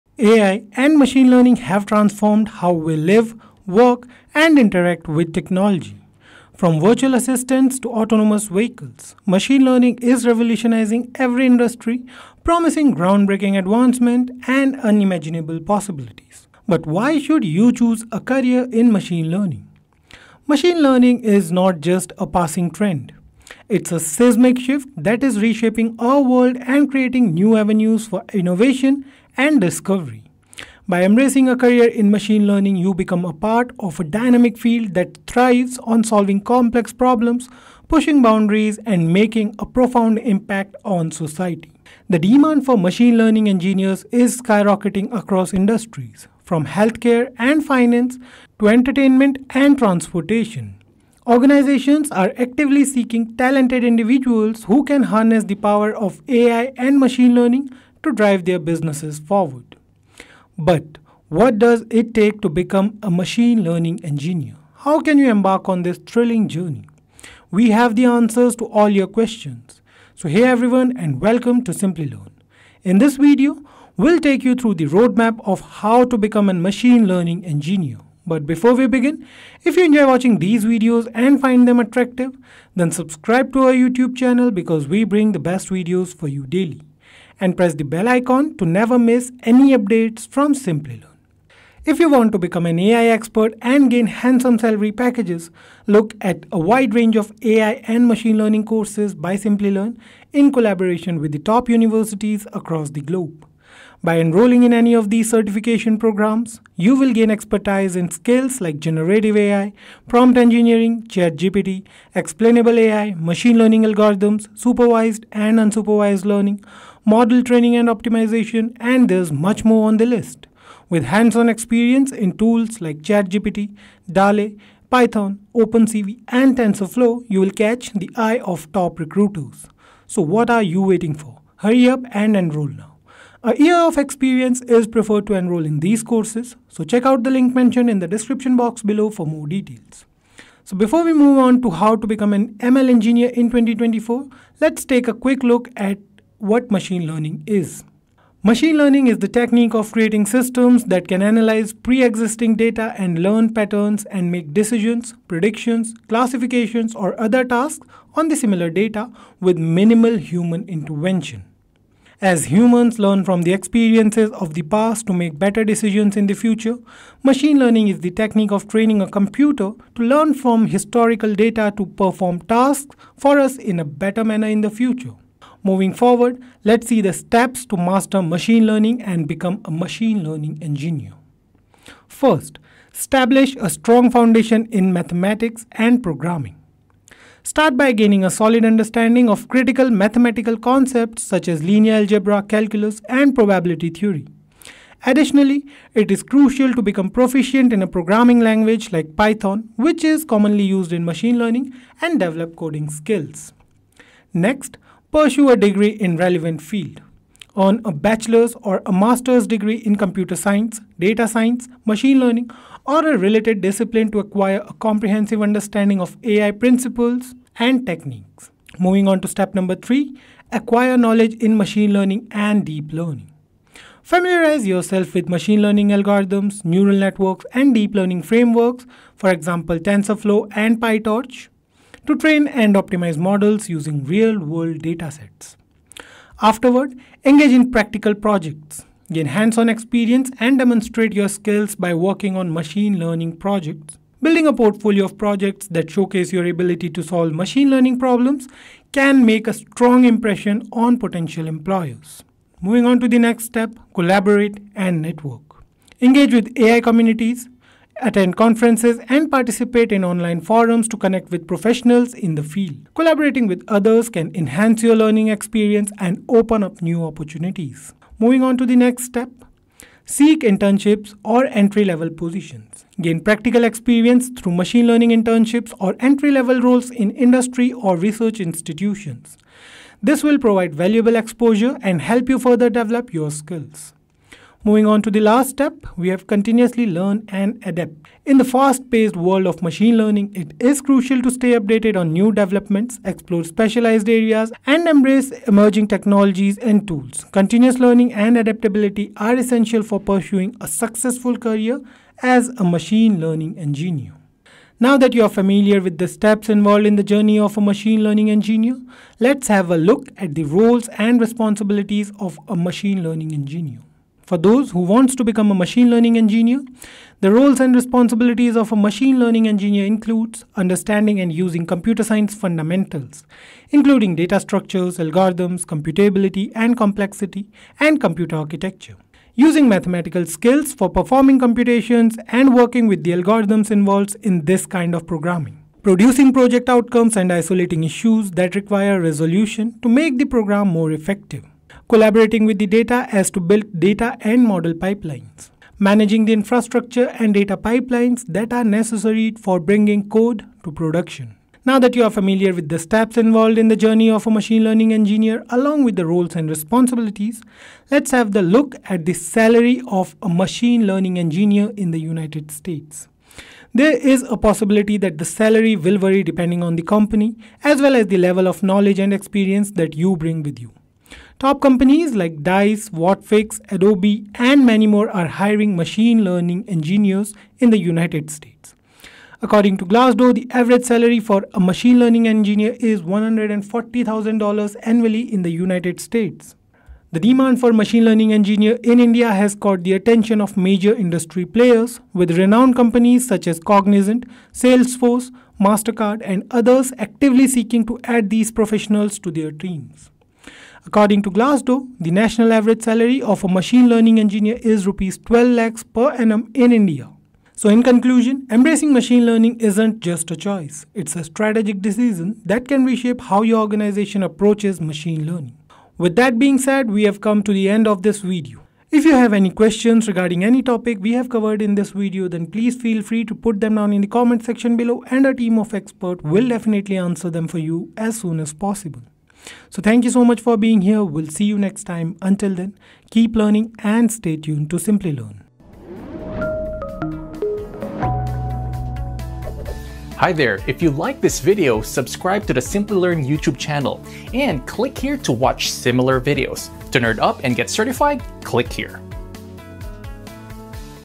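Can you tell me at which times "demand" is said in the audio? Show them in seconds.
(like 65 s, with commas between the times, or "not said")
42 s, 387 s.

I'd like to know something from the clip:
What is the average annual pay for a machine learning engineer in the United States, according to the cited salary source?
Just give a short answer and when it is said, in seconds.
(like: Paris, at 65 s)
$140,000, at 383 s.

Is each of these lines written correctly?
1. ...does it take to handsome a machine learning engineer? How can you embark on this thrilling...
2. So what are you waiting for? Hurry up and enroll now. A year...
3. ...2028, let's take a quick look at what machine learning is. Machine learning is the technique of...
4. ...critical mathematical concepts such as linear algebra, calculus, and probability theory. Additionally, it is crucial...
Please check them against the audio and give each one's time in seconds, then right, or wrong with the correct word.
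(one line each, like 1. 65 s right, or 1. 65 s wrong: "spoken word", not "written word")
1. 61 s wrong: "become", not "handsome"
2. 130 s right
3. 143 s wrong: "2024", not "2028"
4. 189 s right.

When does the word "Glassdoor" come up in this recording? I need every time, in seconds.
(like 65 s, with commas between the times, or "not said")
379 s, 401 s.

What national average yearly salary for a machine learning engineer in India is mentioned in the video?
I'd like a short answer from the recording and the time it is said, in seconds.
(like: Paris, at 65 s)
12 lakhs rupees, at 404 s.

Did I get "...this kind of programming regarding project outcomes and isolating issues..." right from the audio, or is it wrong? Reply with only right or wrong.
wrong.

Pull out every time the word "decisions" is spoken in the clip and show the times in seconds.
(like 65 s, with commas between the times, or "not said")
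154 s, 165 s, 411 s.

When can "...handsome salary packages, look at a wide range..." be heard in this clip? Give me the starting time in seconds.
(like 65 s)
94 s.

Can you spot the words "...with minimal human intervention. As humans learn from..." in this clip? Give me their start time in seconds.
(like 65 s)
159 s.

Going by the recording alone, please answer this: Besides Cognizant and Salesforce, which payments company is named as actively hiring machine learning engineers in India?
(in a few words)
MasterCard.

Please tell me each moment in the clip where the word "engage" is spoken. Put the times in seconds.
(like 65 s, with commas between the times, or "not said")
237 s, 256 s.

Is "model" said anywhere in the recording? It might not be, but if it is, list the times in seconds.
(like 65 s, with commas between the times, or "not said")
117 s, 233 s, 344 s.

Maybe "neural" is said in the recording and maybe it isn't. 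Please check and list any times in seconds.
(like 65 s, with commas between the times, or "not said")
226 s.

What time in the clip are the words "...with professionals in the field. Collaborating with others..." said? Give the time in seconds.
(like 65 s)
261 s.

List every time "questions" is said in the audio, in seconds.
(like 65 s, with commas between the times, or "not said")
69 s, 419 s.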